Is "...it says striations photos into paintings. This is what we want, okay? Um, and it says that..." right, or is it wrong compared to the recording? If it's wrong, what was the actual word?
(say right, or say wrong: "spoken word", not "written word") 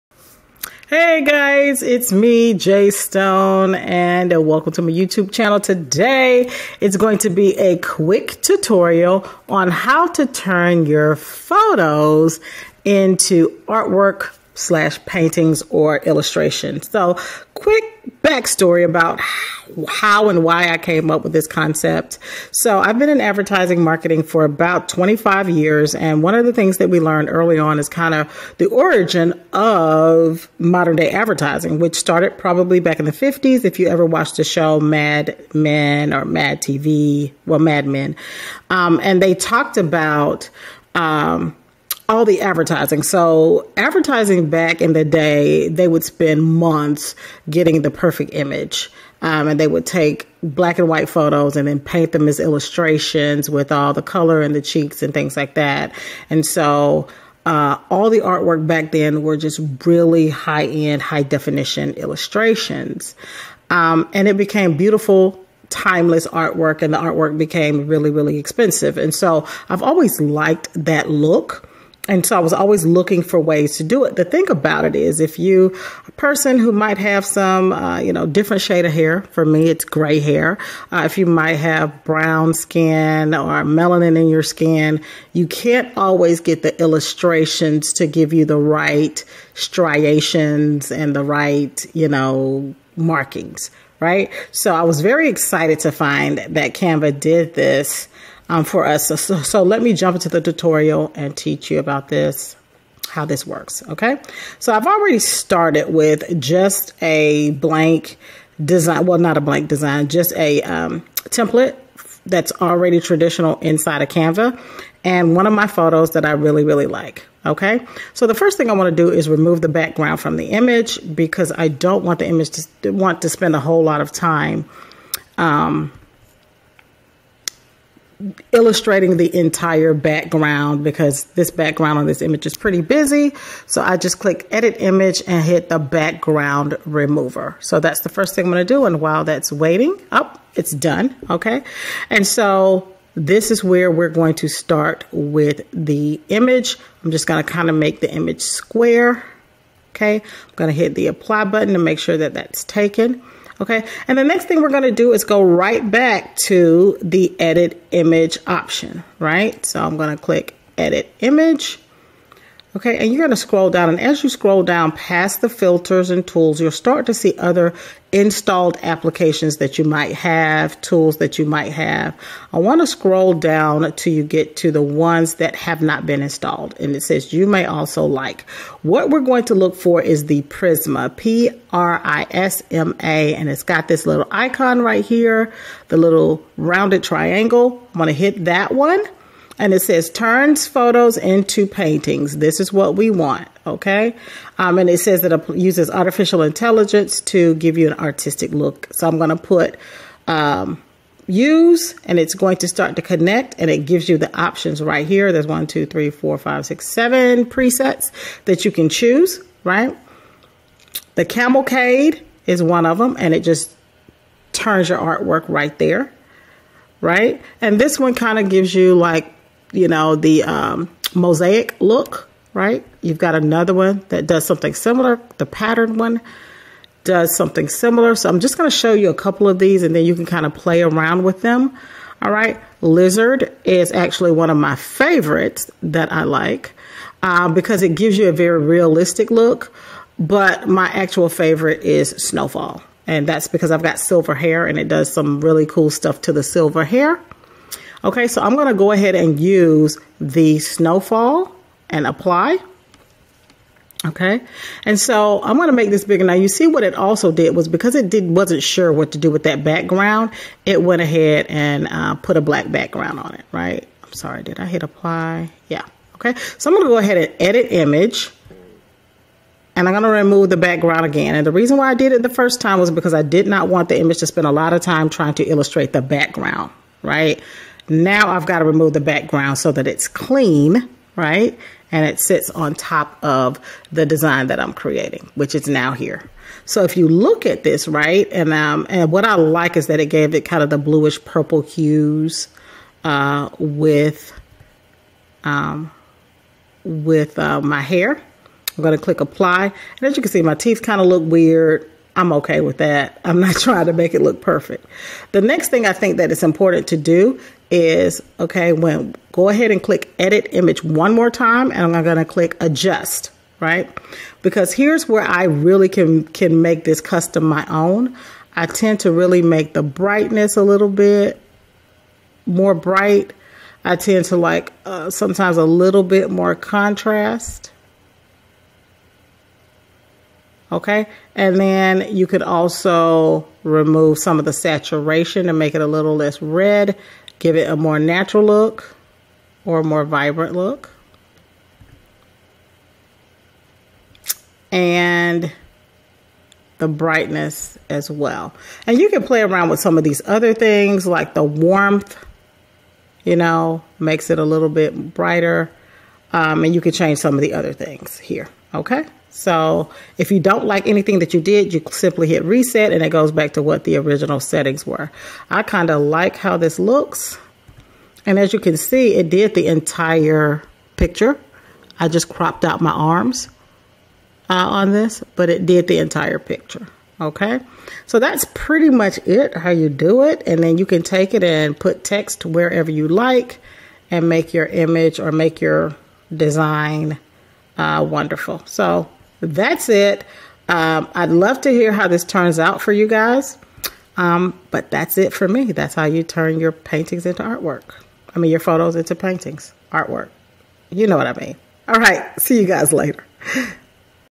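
wrong: "turns", not "striations".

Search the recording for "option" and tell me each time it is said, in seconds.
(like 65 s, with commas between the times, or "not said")
158 s, 204 s.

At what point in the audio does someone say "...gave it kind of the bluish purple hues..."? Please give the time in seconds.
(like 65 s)
290 s.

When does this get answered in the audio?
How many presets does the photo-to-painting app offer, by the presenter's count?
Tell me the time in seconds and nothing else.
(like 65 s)
206 s.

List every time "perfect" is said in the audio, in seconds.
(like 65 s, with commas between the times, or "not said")
47 s, 304 s.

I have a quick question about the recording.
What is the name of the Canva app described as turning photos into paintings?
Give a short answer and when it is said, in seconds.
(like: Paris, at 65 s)
Prisma, at 180 s.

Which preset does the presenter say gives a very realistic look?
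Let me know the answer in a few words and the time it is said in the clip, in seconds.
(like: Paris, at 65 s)
Lizard, at 232 s.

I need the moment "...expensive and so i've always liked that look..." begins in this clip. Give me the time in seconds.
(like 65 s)
68 s.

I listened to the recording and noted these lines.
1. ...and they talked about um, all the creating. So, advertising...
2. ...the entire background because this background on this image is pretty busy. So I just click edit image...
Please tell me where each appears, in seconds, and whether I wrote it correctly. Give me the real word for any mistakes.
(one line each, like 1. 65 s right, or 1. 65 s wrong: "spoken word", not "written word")
1. 39 s wrong: "advertising", not "creating"
2. 129 s right.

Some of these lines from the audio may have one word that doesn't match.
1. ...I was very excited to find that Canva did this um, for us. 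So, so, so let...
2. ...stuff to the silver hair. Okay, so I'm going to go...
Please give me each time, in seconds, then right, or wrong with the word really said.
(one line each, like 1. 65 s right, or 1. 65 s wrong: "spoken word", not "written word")
1. 94 s right
2. 245 s right.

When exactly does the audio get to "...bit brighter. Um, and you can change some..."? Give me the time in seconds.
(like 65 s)
354 s.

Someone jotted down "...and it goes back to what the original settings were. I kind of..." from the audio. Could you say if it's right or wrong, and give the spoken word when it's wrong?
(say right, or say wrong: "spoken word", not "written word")
right.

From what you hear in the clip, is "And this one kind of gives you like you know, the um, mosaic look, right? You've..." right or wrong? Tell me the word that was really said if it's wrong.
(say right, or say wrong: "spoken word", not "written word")
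right.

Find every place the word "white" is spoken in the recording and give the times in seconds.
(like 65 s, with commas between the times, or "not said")
50 s.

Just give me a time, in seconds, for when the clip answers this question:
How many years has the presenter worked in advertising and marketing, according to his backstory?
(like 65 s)
24 s.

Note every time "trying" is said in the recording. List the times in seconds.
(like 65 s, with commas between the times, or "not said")
275 s, 303 s.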